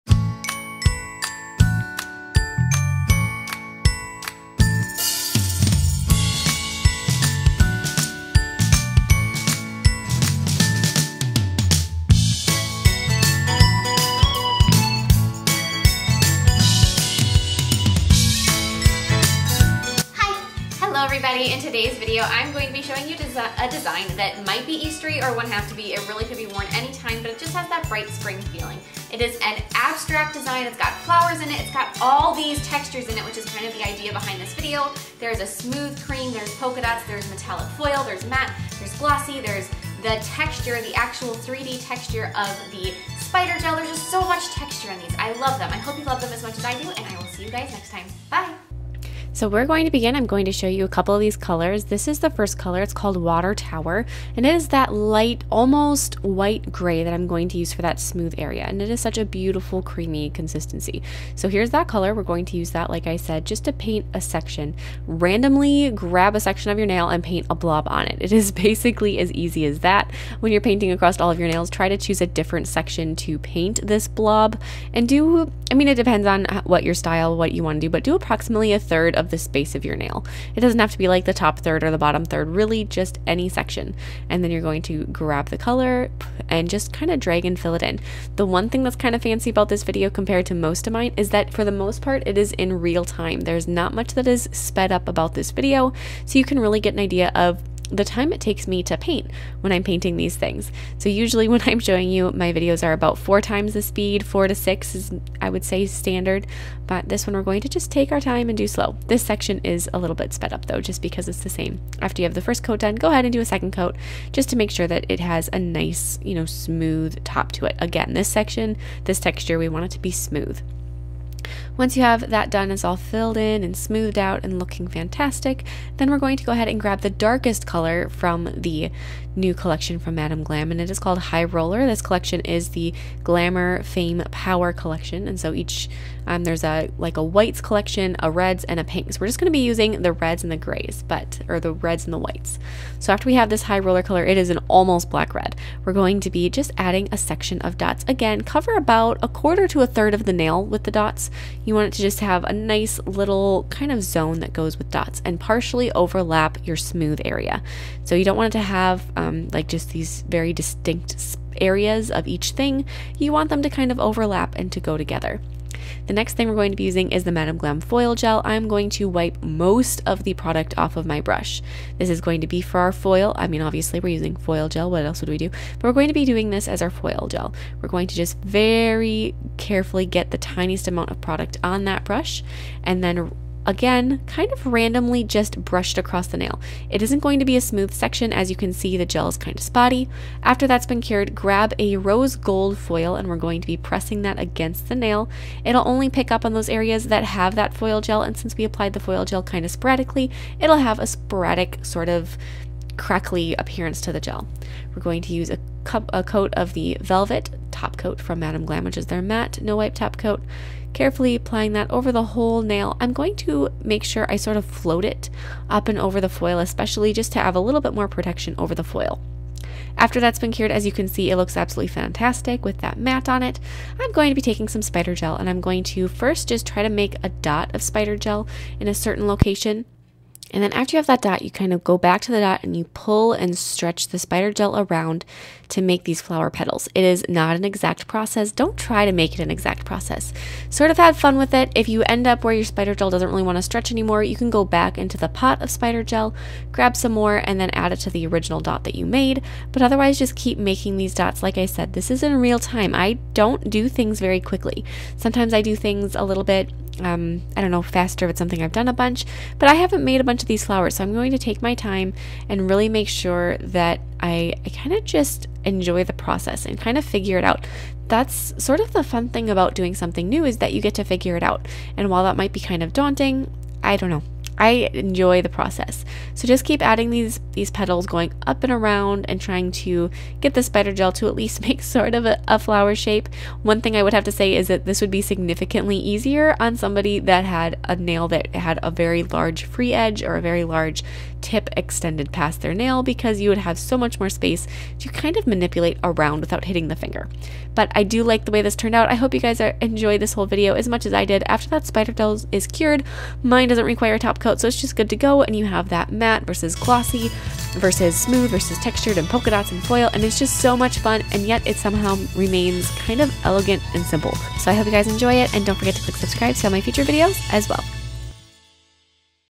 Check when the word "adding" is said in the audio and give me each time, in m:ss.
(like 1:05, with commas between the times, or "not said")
2:26, 4:36.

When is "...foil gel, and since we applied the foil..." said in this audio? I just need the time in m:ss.
3:17.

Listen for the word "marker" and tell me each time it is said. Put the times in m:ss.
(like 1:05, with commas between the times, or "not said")
not said.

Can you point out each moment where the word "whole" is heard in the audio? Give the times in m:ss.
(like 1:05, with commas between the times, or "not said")
3:32, 5:00.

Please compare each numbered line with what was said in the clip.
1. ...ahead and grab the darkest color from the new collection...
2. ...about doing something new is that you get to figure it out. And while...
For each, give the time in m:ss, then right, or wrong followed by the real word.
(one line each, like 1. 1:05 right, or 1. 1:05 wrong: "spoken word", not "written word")
1. 2:06 right
2. 4:29 right.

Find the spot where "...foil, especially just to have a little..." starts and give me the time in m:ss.
3:36.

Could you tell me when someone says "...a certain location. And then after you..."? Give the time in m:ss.
3:48.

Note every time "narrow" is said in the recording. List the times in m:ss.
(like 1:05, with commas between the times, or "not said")
not said.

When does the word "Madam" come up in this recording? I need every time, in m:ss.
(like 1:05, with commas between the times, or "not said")
2:10, 2:47, 3:28.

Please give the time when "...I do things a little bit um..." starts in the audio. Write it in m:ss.
4:15.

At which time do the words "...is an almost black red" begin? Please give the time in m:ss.
2:24.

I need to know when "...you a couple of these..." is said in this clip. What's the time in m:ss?
0:50.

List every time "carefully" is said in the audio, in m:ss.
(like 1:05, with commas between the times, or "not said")
2:59, 3:30.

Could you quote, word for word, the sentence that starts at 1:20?
It doesn't have to be like the top third or the bottom third, really just any section.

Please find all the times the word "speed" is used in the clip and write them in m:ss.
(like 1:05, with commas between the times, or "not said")
1:43.